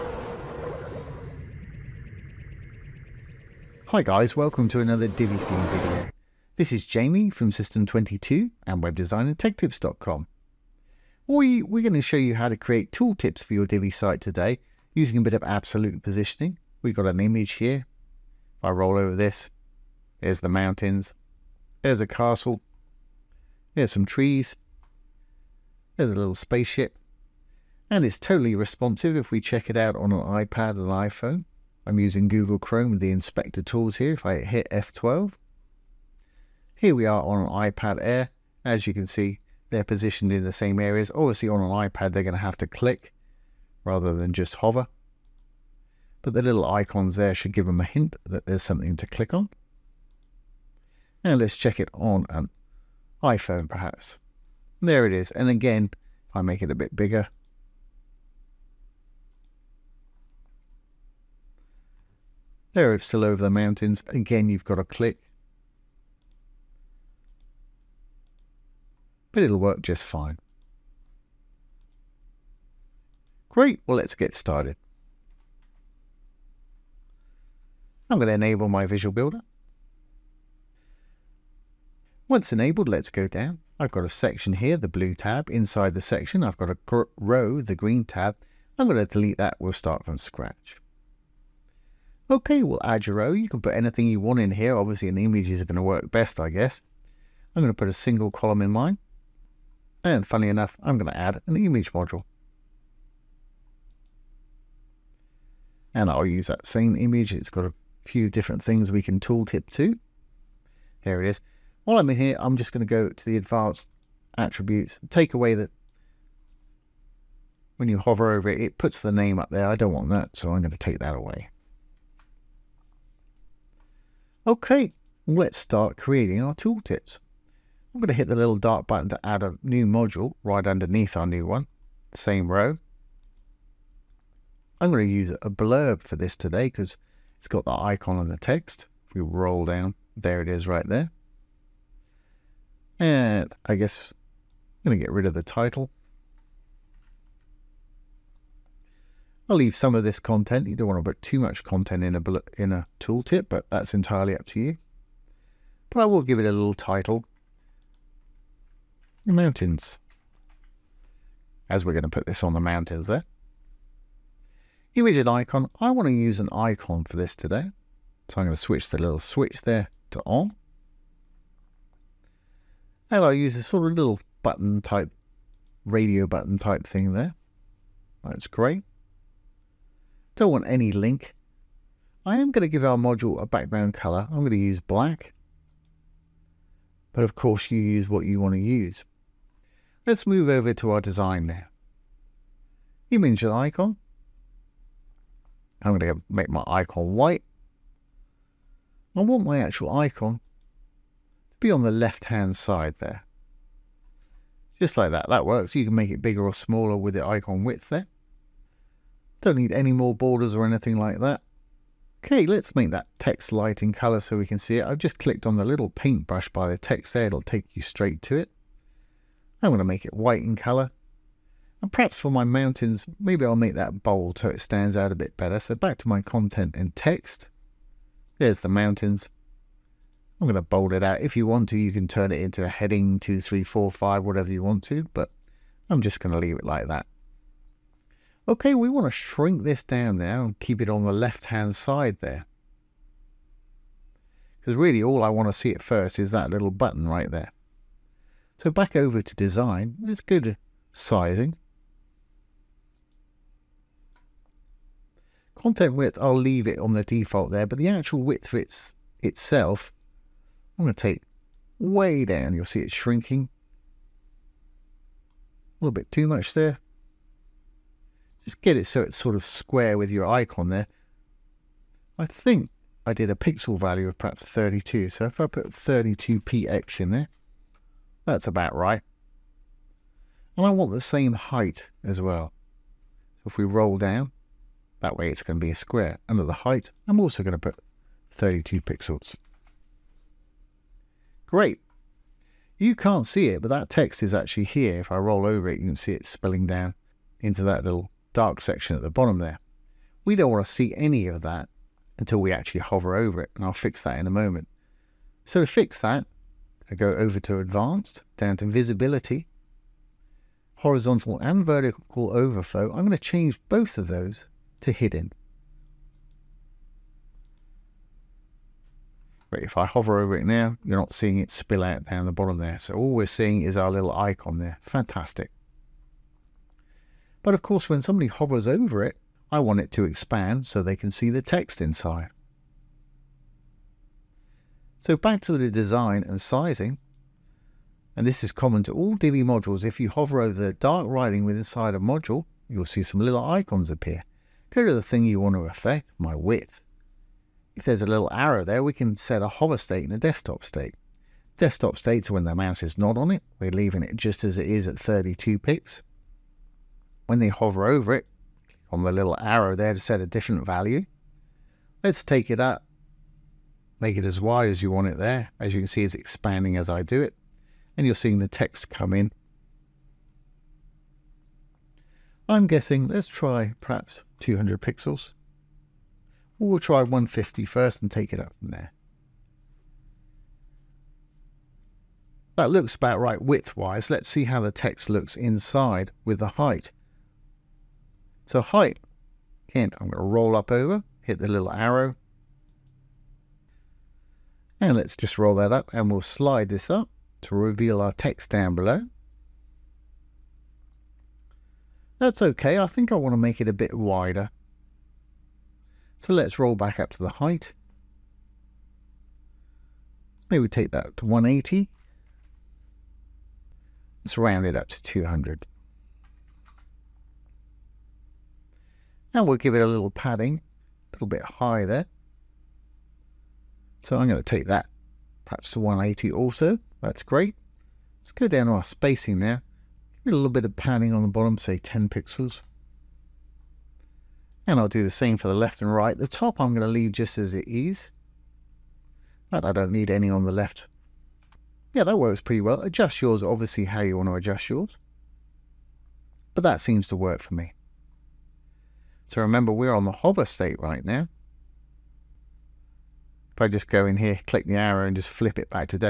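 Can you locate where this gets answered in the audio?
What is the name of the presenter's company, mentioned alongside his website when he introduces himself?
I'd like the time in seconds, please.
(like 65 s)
7 s.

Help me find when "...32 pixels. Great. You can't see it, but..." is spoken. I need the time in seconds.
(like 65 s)
288 s.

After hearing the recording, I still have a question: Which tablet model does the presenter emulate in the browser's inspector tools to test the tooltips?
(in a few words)
iPad Air.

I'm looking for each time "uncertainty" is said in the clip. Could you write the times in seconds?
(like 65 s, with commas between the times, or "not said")
not said.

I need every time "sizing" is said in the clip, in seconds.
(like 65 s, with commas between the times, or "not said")
250 s, 336 s.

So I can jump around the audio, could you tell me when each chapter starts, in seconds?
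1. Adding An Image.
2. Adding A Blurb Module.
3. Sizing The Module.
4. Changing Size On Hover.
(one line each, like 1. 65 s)
1. 88 s
2. 131 s
3. 251 s
4. 340 s.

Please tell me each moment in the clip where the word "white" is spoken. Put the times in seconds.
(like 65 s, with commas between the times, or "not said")
197 s, 220 s.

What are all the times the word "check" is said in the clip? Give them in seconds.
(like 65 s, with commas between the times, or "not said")
29 s, 51 s.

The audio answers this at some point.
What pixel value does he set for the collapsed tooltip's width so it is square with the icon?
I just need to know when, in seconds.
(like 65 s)
275 s.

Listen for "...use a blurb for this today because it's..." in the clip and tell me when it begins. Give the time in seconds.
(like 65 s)
135 s.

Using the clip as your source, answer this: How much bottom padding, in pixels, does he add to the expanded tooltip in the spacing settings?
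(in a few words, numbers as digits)
10 pixels.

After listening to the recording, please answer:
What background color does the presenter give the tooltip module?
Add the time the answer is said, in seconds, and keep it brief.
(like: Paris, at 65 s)
Black, at 184 s.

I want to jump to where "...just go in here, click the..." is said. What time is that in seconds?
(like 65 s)
453 s.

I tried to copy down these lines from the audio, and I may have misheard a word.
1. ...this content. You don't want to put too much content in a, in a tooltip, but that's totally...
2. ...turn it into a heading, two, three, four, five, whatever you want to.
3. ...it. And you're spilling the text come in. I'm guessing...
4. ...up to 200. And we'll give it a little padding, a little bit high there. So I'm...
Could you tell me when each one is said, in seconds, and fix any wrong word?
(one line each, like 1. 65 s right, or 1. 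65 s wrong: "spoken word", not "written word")
1. 150 s wrong: "entirely", not "totally"
2. 232 s right
3. 367 s wrong: "seeing", not "spilling"
4. 414 s right.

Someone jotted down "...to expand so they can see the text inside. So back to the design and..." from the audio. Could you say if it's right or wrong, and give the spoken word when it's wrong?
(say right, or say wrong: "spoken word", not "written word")
right.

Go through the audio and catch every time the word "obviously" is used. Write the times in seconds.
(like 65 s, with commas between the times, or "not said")
41 s, 94 s, 443 s.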